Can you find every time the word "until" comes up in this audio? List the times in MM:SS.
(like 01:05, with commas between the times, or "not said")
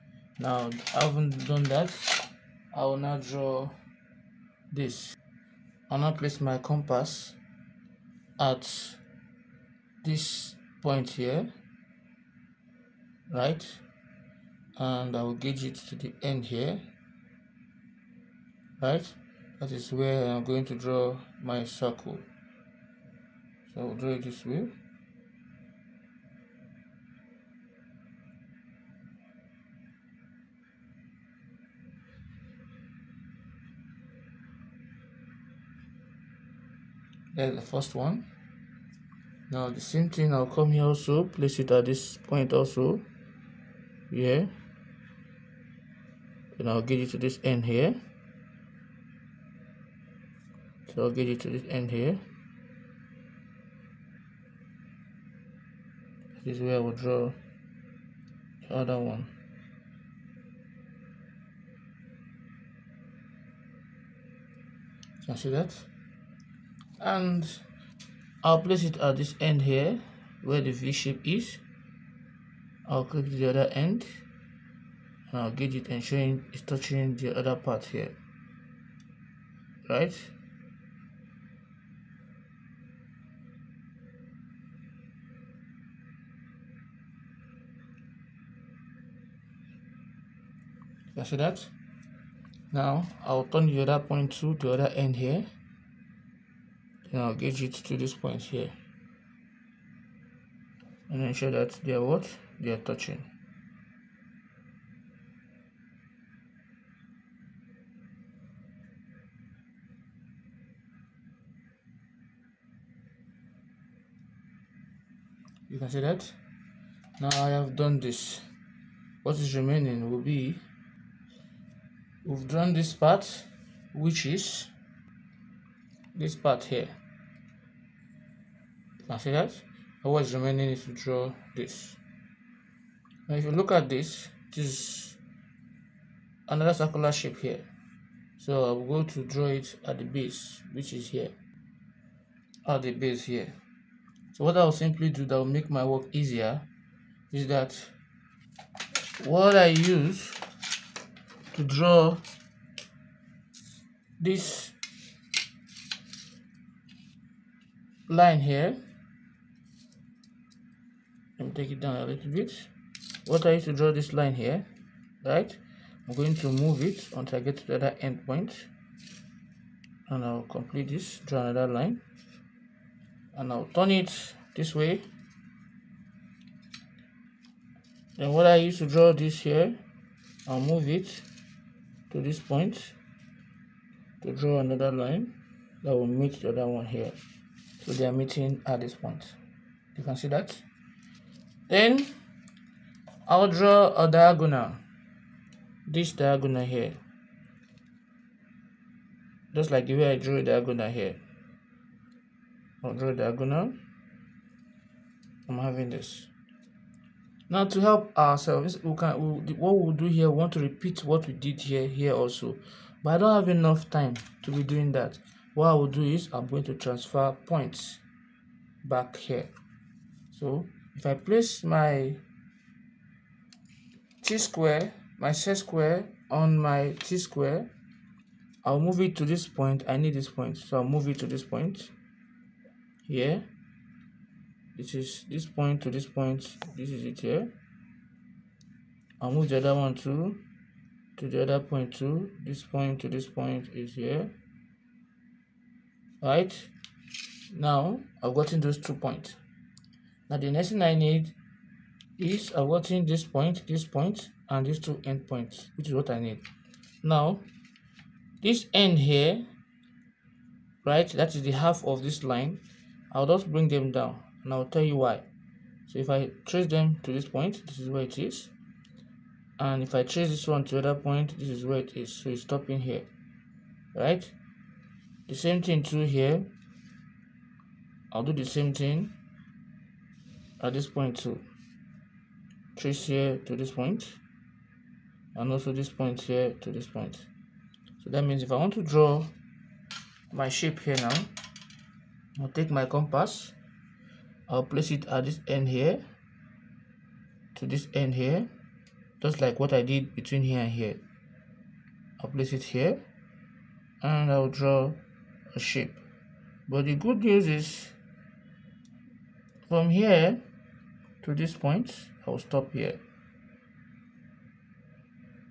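02:47.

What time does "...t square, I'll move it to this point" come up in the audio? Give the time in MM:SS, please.
03:46.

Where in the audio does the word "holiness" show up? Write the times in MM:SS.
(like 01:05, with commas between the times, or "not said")
not said.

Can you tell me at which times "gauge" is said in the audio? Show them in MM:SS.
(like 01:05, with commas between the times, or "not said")
00:15, 01:15, 01:37.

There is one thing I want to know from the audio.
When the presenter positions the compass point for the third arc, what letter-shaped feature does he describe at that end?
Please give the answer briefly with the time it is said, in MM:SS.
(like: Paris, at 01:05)
V shape, at 01:10.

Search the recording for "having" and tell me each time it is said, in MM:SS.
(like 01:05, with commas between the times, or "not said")
00:00, 03:25.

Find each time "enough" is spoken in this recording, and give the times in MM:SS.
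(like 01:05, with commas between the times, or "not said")
03:33.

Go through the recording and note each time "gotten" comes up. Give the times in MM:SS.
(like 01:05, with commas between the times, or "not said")
04:08, 04:12.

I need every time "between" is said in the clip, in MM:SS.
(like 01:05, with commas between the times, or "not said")
05:00.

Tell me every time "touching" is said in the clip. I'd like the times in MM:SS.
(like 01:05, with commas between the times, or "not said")
01:16, 01:42.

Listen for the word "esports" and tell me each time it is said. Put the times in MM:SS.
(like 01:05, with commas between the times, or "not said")
not said.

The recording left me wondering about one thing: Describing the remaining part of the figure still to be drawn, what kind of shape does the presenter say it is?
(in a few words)
circular shape.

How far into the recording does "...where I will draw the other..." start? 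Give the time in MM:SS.
00:56.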